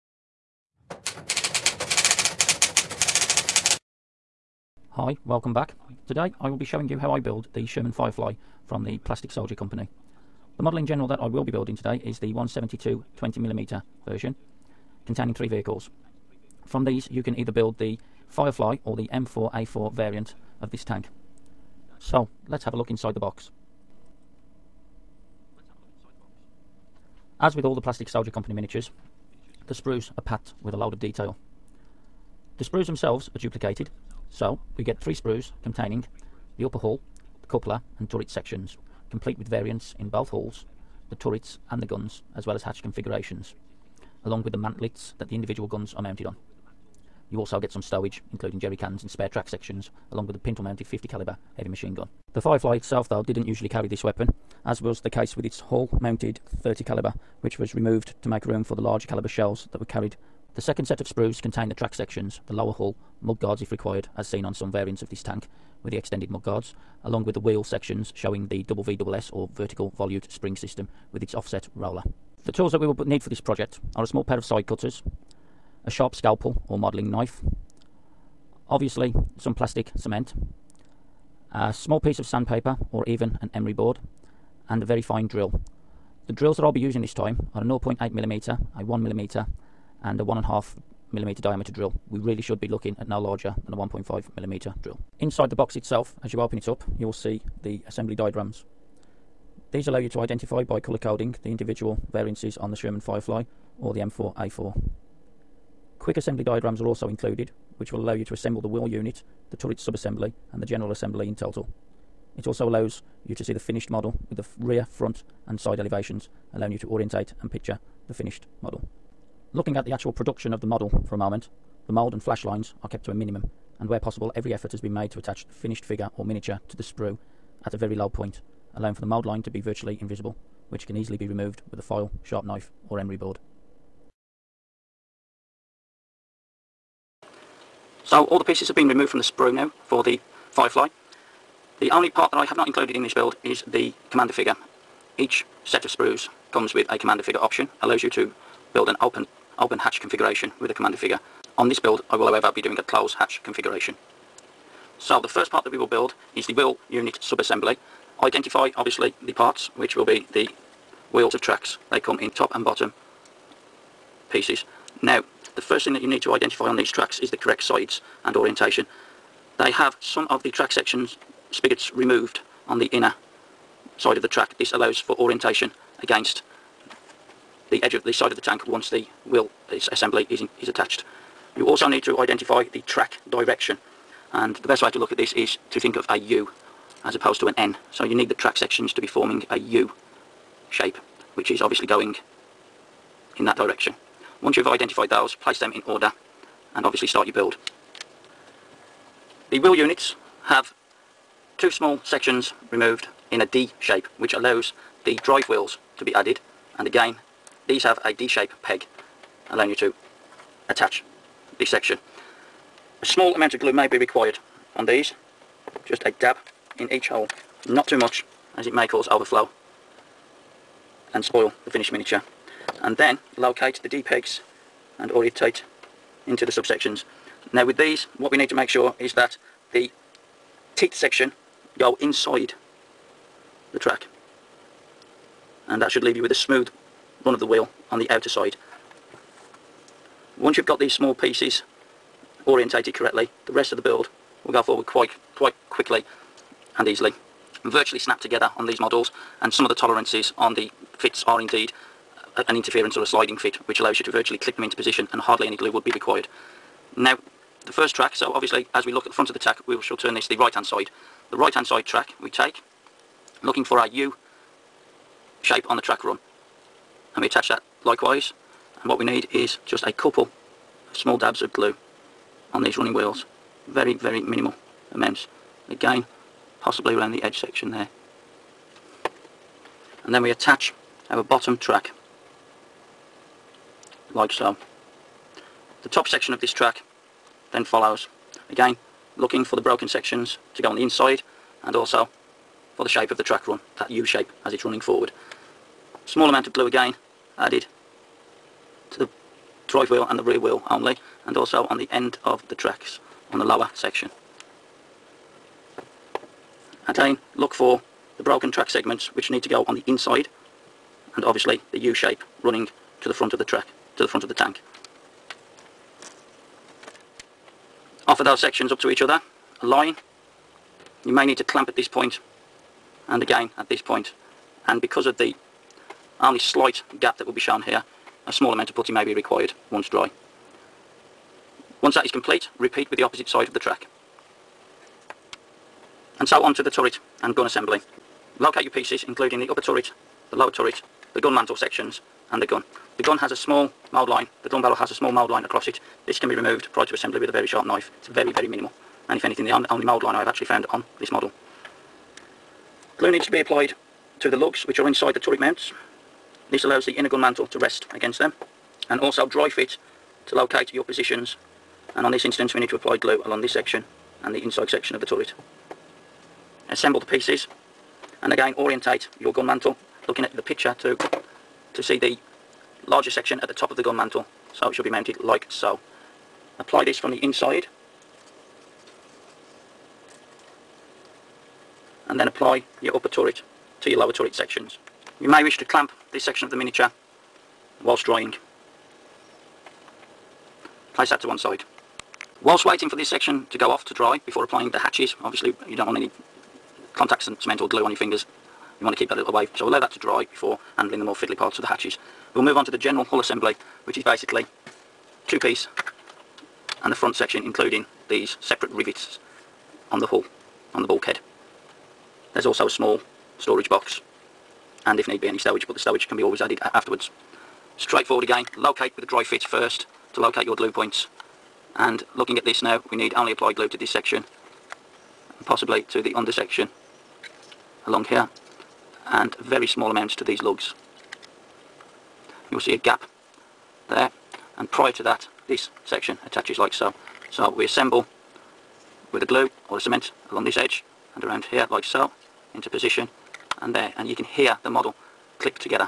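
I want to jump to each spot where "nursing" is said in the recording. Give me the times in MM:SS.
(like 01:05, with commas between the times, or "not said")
not said.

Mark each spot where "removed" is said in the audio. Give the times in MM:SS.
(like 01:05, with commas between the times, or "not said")
00:57, 02:11, 02:18, 02:51, 03:22, 05:46.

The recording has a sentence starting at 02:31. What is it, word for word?
On this build I will however be doing a close hatch configuration.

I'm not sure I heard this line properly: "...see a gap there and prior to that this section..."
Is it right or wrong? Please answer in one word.
right.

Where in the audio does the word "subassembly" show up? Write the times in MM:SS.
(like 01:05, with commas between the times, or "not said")
01:49, 02:37.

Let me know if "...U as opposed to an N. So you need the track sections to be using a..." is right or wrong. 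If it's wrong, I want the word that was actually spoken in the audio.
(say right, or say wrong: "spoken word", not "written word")
wrong: "forming", not "using".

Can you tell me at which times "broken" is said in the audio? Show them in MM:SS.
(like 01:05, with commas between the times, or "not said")
04:49, 05:08.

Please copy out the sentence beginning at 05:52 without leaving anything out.
Glue needs to be applied to the lugs which are inside the turret mounts.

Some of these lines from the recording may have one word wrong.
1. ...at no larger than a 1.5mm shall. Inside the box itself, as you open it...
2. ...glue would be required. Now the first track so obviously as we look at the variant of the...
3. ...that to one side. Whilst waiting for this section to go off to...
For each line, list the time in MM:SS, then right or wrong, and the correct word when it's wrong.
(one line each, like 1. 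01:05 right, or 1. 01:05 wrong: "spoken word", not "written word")
1. 01:33 wrong: "drill", not "shall"
2. 04:15 wrong: "front", not "variant"
3. 06:31 right.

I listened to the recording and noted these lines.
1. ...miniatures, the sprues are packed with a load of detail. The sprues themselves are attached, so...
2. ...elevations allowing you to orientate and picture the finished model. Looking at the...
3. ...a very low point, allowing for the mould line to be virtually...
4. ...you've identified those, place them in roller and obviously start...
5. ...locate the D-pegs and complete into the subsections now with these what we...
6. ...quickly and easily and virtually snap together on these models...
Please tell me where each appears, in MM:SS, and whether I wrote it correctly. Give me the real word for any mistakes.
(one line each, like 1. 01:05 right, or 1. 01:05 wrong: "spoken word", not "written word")
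1. 00:28 wrong: "duplicated", not "attached"
2. 01:55 right
3. 02:07 right
4. 03:14 wrong: "order", not "roller"
5. 03:43 wrong: "orientate", not "complete"
6. 04:05 right.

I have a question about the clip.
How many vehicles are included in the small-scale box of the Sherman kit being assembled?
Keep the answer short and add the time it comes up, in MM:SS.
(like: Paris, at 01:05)
3, at 00:15.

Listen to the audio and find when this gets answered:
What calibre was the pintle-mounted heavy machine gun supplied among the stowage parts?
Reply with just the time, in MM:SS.
00:50.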